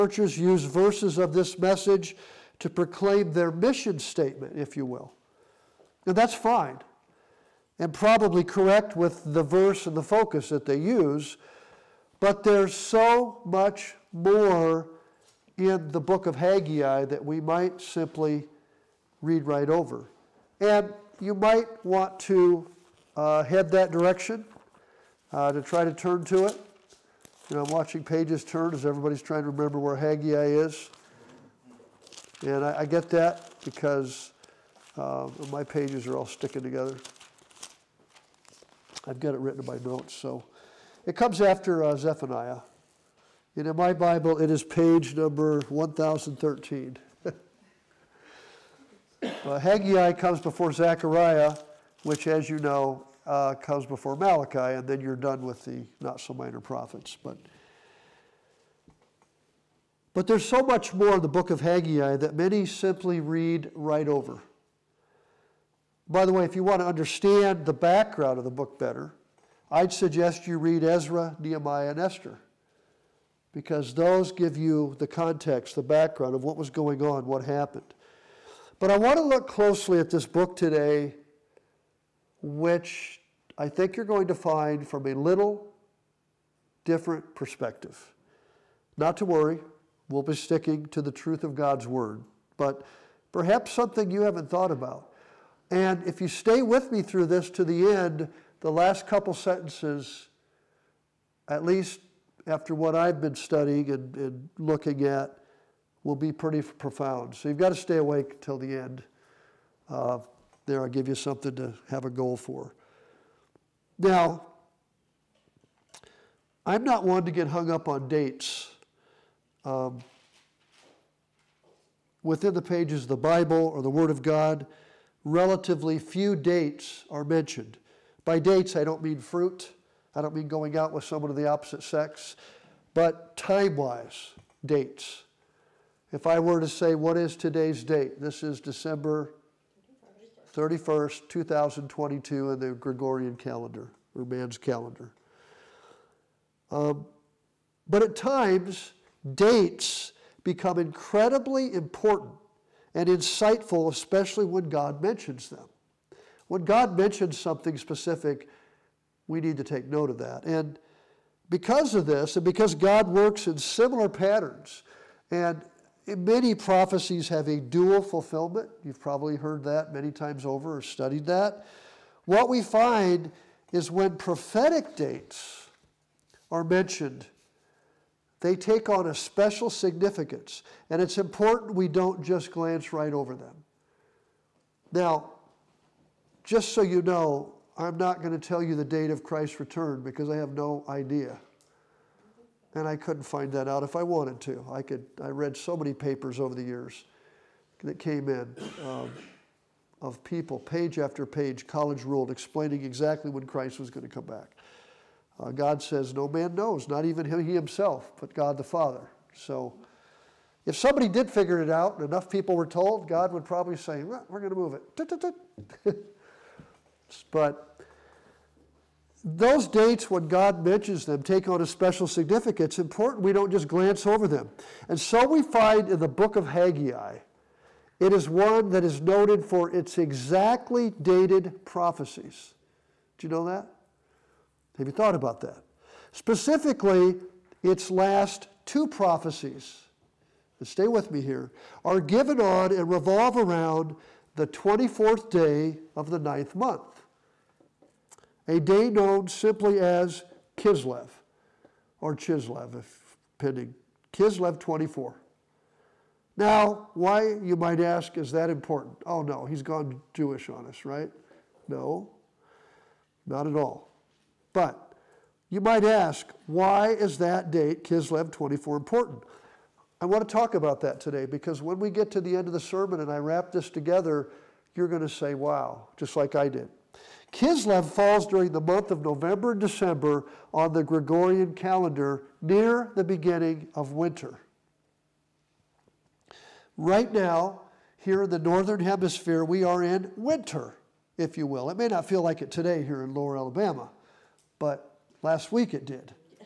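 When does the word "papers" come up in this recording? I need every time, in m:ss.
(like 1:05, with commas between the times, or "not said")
3:15.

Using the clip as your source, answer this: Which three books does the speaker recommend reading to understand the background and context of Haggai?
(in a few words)
Ezra, Nehemiah, and Esther.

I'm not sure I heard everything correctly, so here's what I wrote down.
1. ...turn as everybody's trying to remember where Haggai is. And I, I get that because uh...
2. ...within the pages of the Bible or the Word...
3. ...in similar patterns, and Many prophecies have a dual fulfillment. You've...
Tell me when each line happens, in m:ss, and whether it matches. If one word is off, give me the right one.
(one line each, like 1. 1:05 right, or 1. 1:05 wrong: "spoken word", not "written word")
1. 0:28 right
2. 2:02 right
3. 2:43 right.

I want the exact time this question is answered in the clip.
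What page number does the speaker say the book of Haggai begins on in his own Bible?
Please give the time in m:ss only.
0:45.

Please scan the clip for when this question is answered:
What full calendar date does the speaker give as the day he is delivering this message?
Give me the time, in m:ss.
2:18.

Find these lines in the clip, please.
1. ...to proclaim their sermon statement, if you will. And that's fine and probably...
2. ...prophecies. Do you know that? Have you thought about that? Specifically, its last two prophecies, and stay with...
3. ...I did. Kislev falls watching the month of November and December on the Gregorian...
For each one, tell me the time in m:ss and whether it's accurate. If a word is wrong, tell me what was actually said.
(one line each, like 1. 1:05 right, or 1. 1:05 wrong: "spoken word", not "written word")
1. 0:02 wrong: "mission", not "sermon"
2. 3:51 right
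3. 4:36 wrong: "during", not "watching".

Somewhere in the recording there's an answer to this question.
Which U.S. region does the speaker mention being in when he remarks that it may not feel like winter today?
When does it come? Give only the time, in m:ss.
4:53.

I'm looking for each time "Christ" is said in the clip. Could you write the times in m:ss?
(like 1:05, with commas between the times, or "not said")
3:09, 3:23.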